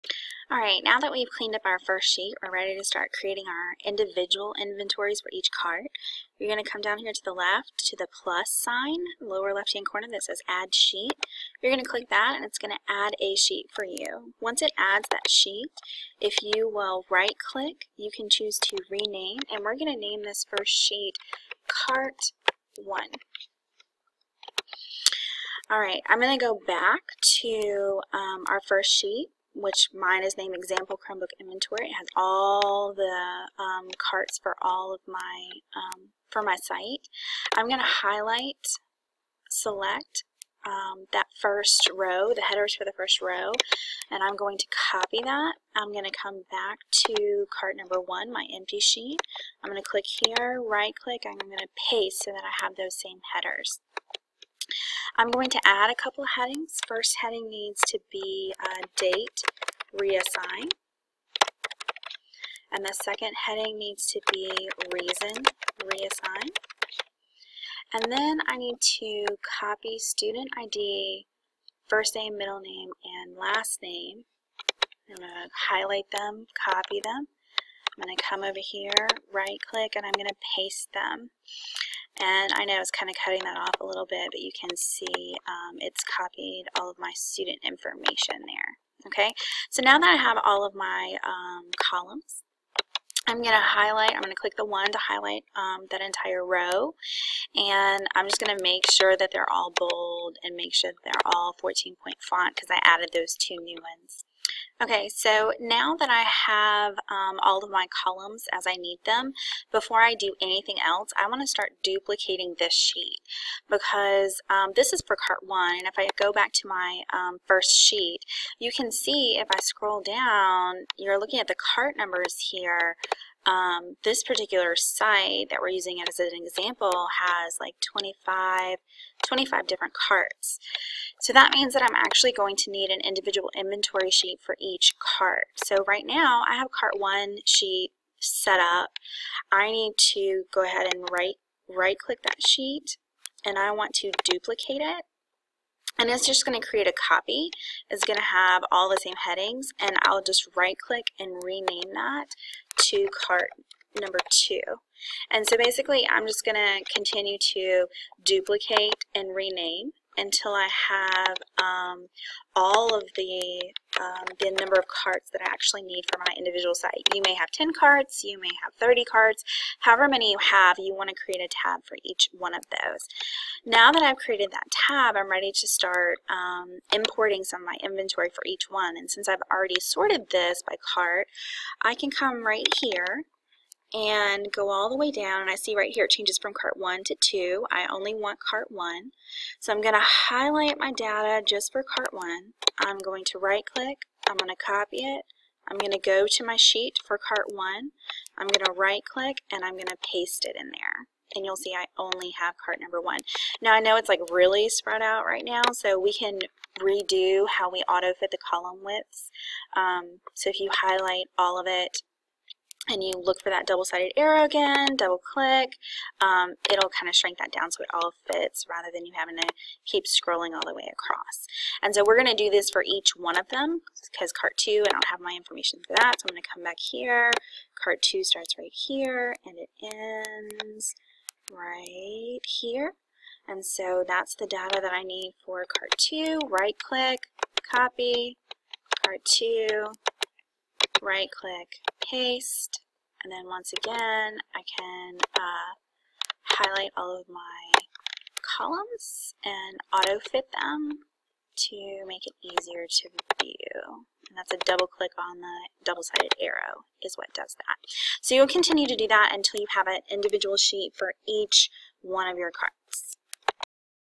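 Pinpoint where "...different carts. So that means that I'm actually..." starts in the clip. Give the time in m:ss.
2:09.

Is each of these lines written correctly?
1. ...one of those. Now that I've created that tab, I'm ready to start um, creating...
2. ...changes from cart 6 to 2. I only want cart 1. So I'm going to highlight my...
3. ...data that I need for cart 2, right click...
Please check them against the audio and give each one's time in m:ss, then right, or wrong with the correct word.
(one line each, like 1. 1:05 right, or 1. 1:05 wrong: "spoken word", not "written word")
1. 2:52 wrong: "importing", not "creating"
2. 3:06 wrong: "1", not "6"
3. 3:54 right.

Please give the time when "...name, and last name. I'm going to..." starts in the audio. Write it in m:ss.
1:12.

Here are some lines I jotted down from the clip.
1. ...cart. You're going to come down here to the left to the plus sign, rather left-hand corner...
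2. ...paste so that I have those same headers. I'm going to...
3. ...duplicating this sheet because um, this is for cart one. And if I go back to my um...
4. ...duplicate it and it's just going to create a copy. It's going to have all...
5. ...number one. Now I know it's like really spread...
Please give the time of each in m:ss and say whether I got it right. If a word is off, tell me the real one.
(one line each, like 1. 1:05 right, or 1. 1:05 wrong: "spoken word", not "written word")
1. 0:05 wrong: "lower", not "rather"
2. 0:51 right
3. 1:51 right
4. 2:24 right
5. 3:22 right.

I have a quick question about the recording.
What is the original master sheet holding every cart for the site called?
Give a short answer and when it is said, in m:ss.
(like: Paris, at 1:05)
Example Chromebook Inventory, at 0:30.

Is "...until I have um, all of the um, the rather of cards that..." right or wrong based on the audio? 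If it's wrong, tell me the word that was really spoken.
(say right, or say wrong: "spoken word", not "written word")
wrong: "number", not "rather".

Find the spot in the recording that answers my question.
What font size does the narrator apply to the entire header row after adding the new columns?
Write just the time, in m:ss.
1:41.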